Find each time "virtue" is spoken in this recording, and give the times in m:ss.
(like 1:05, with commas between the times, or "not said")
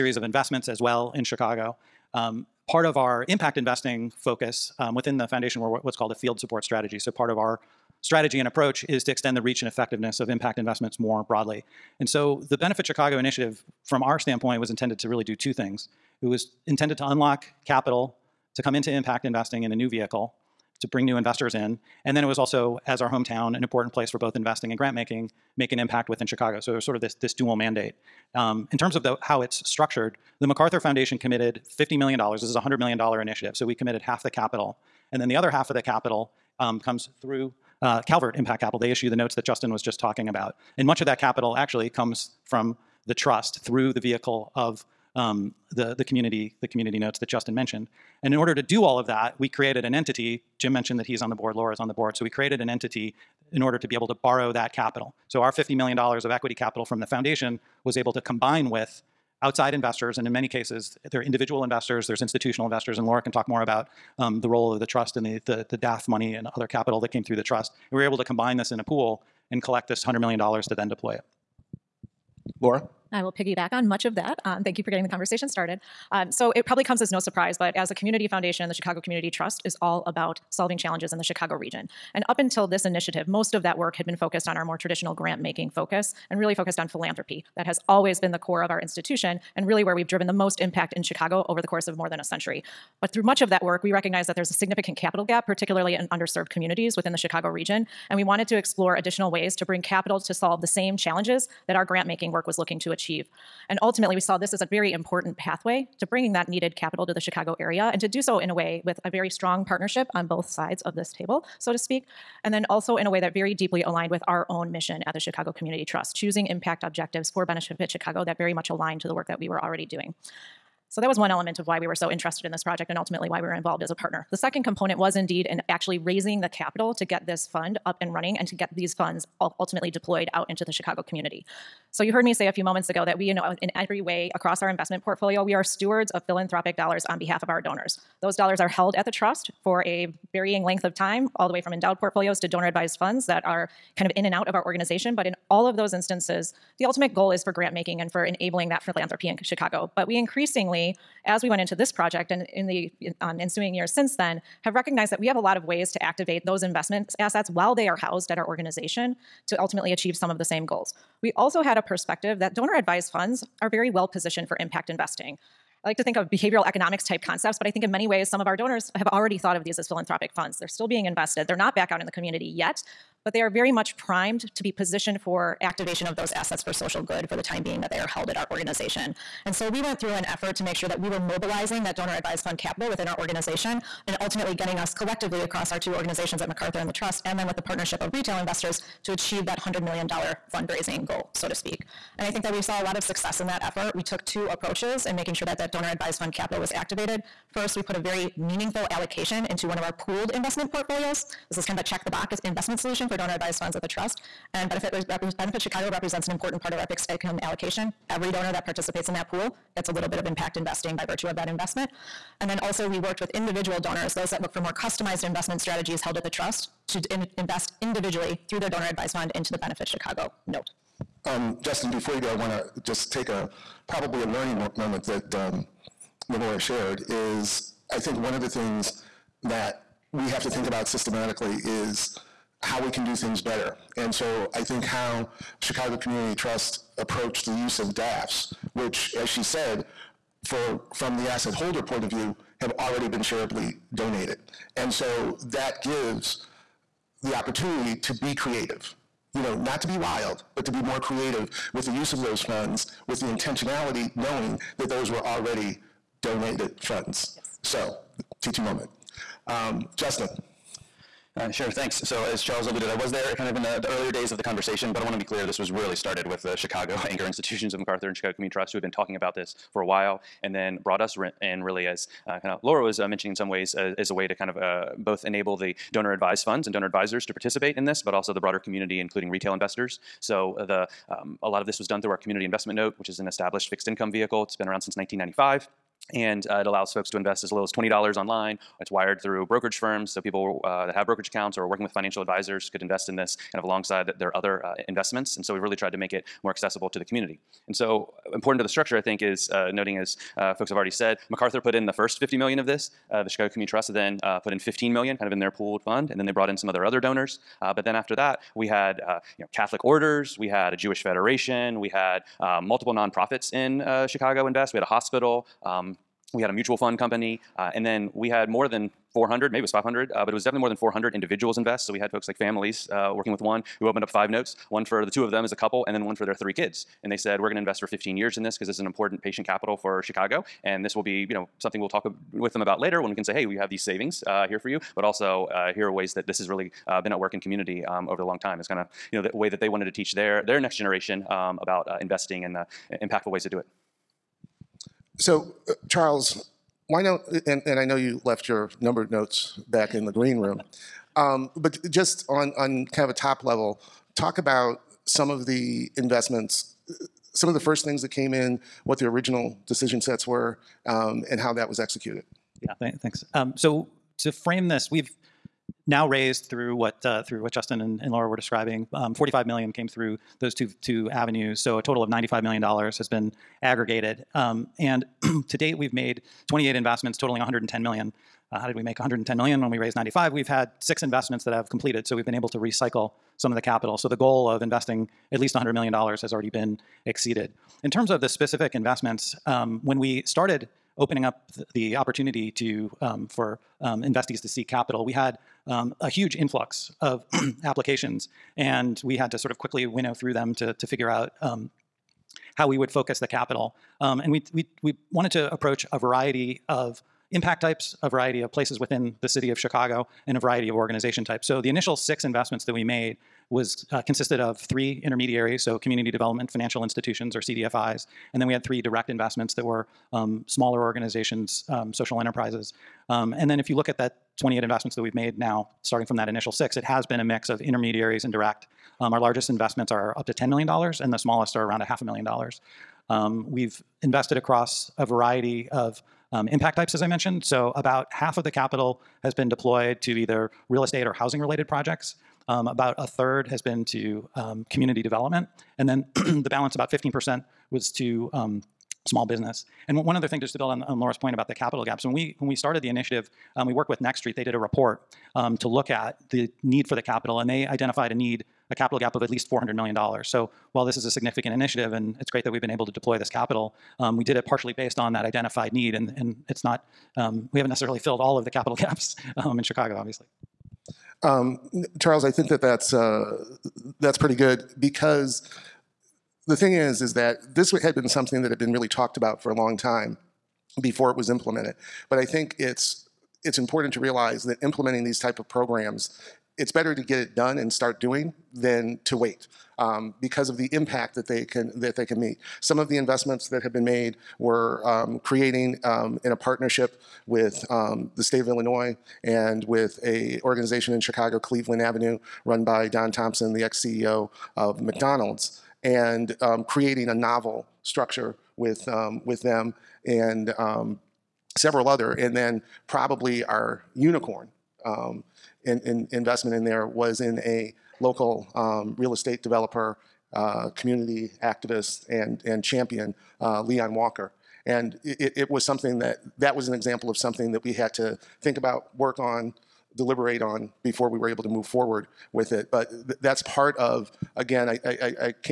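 3:31.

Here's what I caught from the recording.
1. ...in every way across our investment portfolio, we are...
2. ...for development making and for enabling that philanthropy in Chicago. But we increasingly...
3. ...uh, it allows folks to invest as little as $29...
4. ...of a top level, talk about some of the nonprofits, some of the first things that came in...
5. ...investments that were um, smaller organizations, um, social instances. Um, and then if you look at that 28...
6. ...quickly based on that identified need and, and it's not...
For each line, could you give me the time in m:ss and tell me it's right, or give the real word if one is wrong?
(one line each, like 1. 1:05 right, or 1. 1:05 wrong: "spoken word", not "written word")
1. 2:13 right
2. 2:27 wrong: "grant", not "development"
3. 4:46 wrong: "20", not "29"
4. 5:53 wrong: "investments", not "nonprofits"
5. 6:59 wrong: "enterprises", not "instances"
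6. 7:44 wrong: "partially", not "quickly".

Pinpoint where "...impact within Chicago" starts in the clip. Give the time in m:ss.
0:25.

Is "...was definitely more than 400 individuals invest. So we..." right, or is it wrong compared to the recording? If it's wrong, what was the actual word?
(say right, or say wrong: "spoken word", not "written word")
right.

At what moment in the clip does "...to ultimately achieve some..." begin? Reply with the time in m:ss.
2:39.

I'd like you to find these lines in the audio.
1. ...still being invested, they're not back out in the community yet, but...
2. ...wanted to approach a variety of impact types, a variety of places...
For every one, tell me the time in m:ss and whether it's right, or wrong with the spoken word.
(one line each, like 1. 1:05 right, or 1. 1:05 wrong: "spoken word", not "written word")
1. 2:50 right
2. 6:45 right.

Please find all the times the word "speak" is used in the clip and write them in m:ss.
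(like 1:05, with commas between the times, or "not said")
1:51, 3:11.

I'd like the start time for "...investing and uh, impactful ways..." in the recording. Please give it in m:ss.
5:42.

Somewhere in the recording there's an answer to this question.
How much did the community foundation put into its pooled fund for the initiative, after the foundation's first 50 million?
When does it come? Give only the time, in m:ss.
5:04.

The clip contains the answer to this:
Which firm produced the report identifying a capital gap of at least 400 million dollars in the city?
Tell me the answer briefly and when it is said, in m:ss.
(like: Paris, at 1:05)
Next Street, at 7:34.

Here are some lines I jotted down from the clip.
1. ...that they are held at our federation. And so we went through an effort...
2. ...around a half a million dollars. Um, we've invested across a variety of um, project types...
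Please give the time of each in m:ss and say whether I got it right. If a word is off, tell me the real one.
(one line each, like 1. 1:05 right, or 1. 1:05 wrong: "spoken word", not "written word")
1. 2:57 wrong: "organization", not "federation"
2. 7:11 wrong: "impact", not "project".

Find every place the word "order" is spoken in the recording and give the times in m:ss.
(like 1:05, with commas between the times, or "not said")
0:48, 0:53, 5:09.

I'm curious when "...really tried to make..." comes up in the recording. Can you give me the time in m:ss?
4:55.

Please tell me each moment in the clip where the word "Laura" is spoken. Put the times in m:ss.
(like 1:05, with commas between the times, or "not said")
0:51, 1:03, 1:12, 3:46, 4:32, 6:08, 7:30.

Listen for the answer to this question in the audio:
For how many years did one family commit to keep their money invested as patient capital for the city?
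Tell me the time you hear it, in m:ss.
5:27.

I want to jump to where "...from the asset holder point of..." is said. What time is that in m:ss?
4:00.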